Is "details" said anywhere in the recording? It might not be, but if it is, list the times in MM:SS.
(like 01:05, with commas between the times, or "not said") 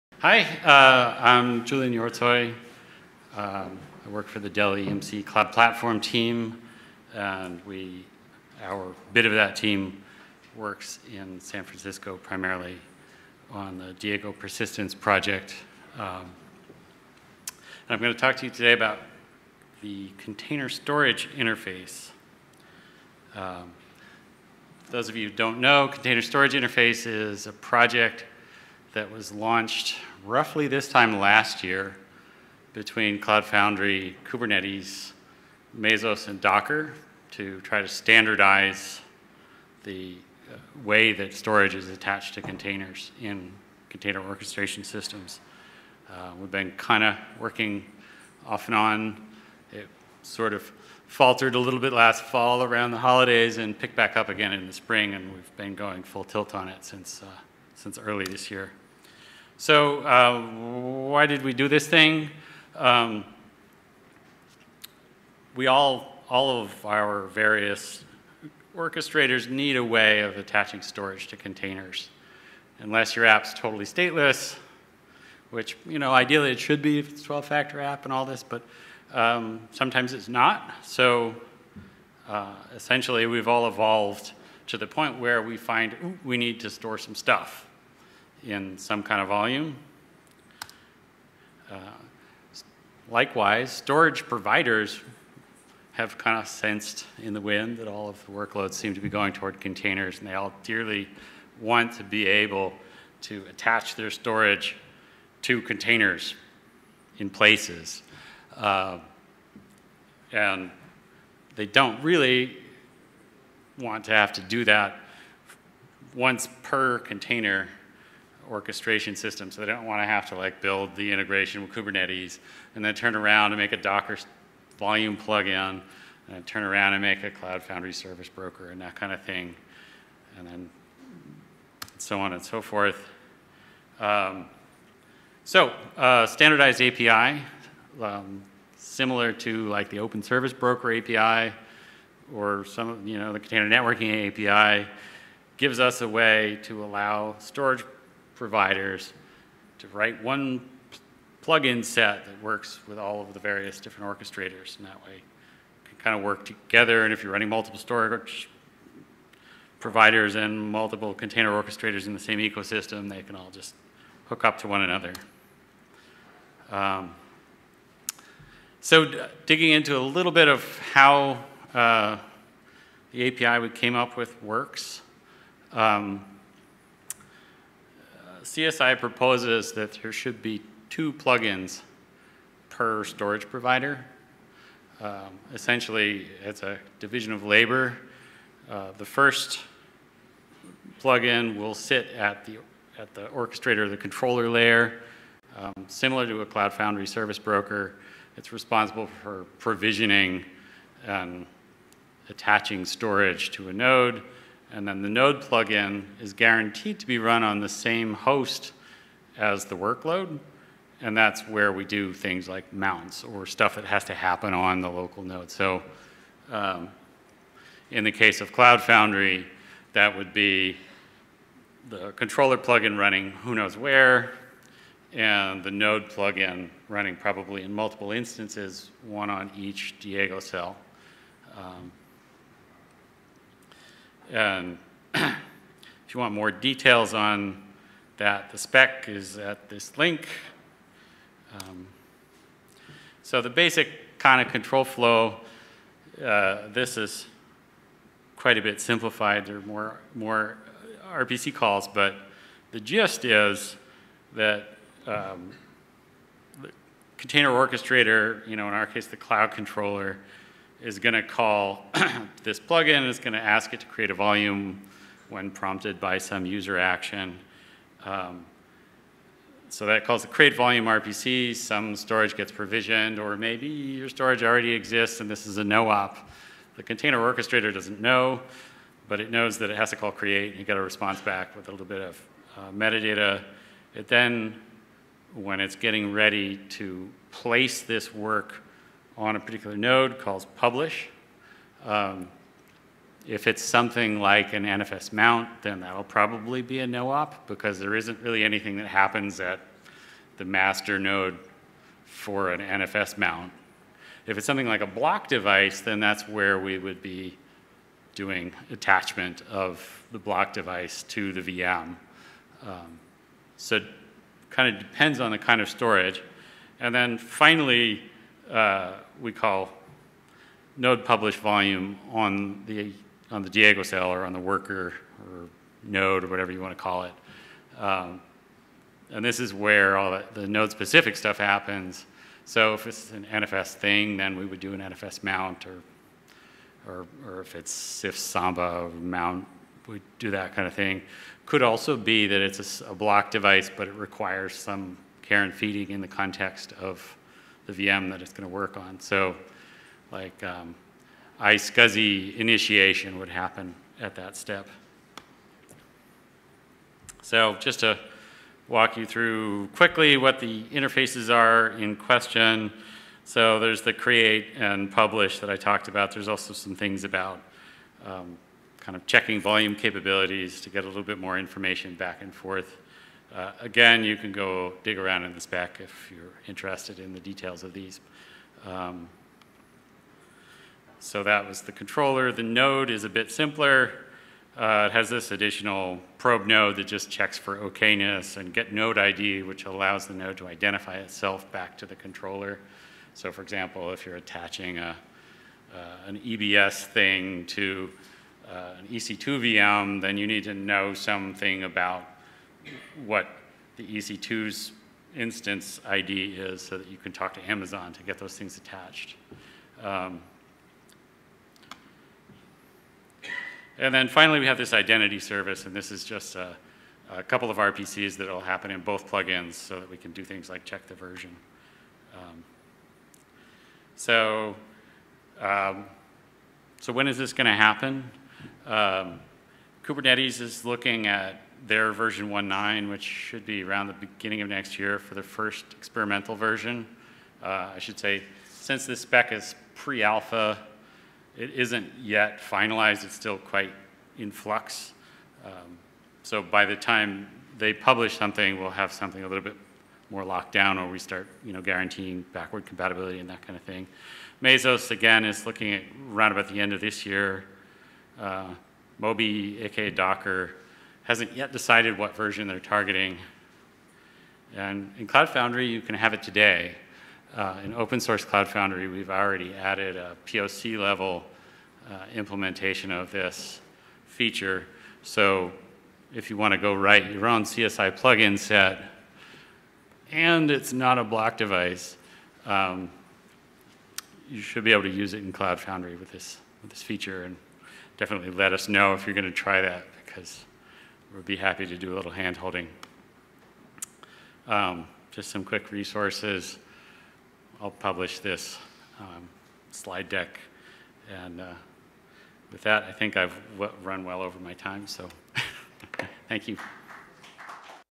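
03:56, 06:17.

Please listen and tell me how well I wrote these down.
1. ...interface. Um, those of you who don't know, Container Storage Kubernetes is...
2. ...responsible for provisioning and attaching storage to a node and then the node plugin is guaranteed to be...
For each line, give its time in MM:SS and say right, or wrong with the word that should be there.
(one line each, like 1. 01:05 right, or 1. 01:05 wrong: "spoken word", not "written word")
1. 00:21 wrong: "Interface", not "Kubernetes"
2. 03:18 right.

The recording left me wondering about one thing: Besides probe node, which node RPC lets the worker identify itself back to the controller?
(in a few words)
get node ID.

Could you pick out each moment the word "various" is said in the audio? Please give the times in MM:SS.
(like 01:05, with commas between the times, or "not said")
01:07, 02:33.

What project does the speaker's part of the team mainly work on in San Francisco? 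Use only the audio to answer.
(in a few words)
Diego Persistence Project.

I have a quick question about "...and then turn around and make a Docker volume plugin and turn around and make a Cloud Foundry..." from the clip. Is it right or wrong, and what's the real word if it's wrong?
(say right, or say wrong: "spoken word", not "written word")
right.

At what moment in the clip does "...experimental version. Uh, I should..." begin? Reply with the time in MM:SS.
07:15.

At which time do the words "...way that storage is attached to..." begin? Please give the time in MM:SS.
00:40.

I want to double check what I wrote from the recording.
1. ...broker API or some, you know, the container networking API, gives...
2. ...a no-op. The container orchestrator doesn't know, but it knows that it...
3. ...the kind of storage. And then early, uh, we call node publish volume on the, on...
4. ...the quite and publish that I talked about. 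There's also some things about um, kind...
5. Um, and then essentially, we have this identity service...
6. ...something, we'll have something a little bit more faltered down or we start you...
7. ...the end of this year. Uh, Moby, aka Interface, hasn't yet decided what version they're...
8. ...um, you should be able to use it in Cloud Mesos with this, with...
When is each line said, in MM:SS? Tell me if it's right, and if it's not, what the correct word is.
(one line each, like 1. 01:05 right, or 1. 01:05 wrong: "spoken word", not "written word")
1. 02:20 right
2. 04:35 right
3. 05:15 wrong: "finally", not "early"
4. 06:03 wrong: "create", not "quite"
5. 06:49 wrong: "finally", not "essentially"
6. 07:28 wrong: "locked", not "faltered"
7. 07:36 wrong: "Docker", not "Interface"
8. 08:02 wrong: "Foundry", not "Mesos".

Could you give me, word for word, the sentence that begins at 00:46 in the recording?
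Uh, we've been kind of working off and on.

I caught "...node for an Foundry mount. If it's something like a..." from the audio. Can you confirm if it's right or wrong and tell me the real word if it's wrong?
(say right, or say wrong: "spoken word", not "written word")
wrong: "NFS", not "Foundry".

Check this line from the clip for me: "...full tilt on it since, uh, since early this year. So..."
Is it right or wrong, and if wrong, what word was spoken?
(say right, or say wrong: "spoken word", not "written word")
right.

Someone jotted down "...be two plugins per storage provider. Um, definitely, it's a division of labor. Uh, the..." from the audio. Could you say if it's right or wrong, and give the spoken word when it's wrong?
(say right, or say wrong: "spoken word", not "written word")
wrong: "essentially", not "definitely".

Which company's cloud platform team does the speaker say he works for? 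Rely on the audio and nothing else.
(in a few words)
Dell EMC.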